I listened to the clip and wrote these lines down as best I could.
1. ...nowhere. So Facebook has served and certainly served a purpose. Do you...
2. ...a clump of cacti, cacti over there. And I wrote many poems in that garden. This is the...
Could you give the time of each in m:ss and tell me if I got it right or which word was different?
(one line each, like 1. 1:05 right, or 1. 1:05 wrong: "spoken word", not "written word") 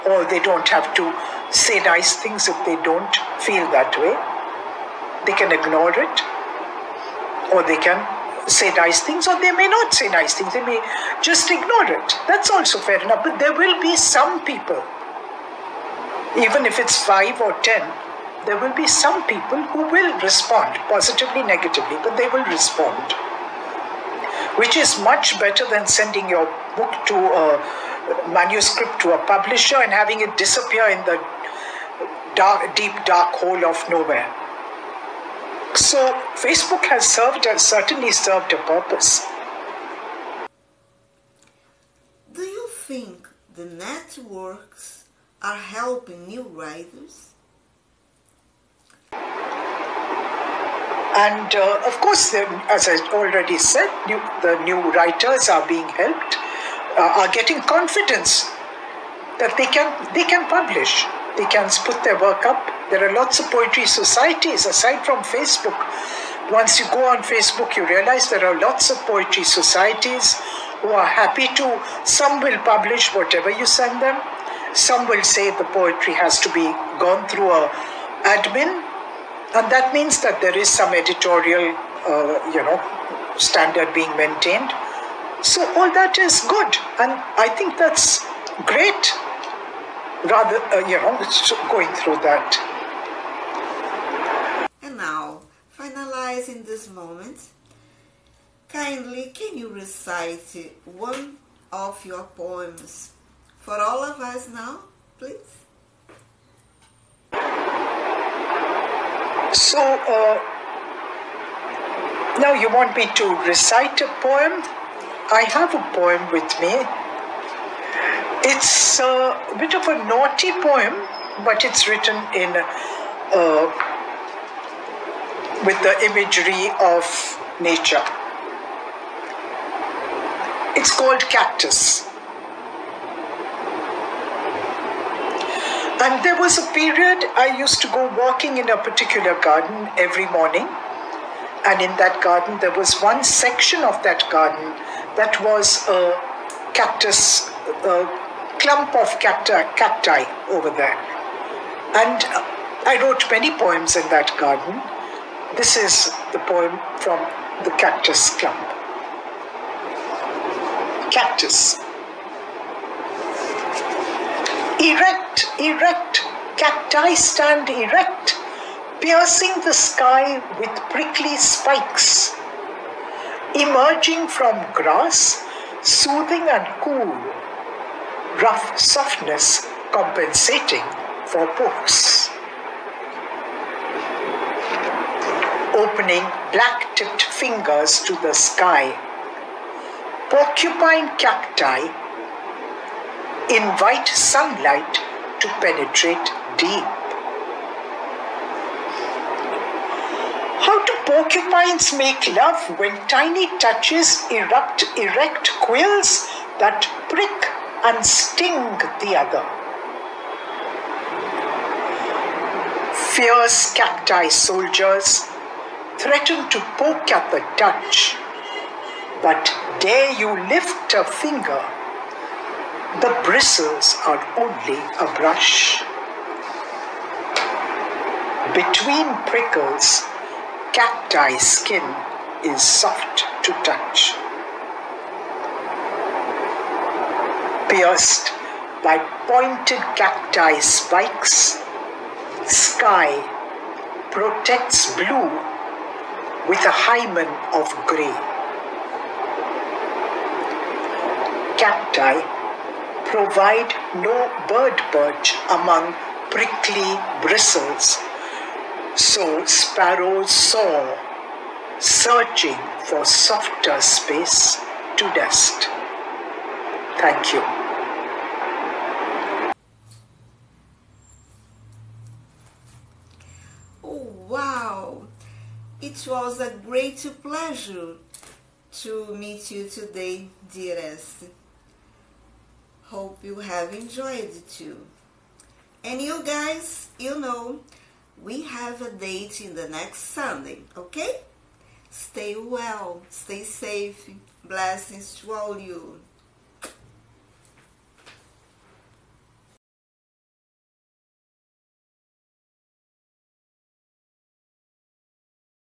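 1. 0:33 right
2. 2:27 right.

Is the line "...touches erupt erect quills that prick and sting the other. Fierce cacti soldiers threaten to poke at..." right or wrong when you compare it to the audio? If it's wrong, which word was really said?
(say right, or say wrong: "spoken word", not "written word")
right.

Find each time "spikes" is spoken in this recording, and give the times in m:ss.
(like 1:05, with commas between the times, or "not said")
2:51, 4:00.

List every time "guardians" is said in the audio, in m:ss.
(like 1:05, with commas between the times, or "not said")
not said.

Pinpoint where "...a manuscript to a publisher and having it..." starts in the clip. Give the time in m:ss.
0:27.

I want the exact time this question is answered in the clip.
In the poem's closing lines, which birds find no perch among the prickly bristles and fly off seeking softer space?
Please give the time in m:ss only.
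4:19.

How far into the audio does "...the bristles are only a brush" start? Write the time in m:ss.
3:43.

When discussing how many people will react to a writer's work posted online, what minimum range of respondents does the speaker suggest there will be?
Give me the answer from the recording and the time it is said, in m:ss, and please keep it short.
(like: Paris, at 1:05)
5 or 10, at 0:17.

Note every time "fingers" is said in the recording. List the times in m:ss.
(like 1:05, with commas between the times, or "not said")
3:07, 3:41.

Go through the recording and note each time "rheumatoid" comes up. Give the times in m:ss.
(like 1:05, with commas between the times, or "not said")
not said.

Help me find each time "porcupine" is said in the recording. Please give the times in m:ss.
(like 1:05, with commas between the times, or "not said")
3:10, 3:21.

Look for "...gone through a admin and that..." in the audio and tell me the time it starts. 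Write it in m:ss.
1:17.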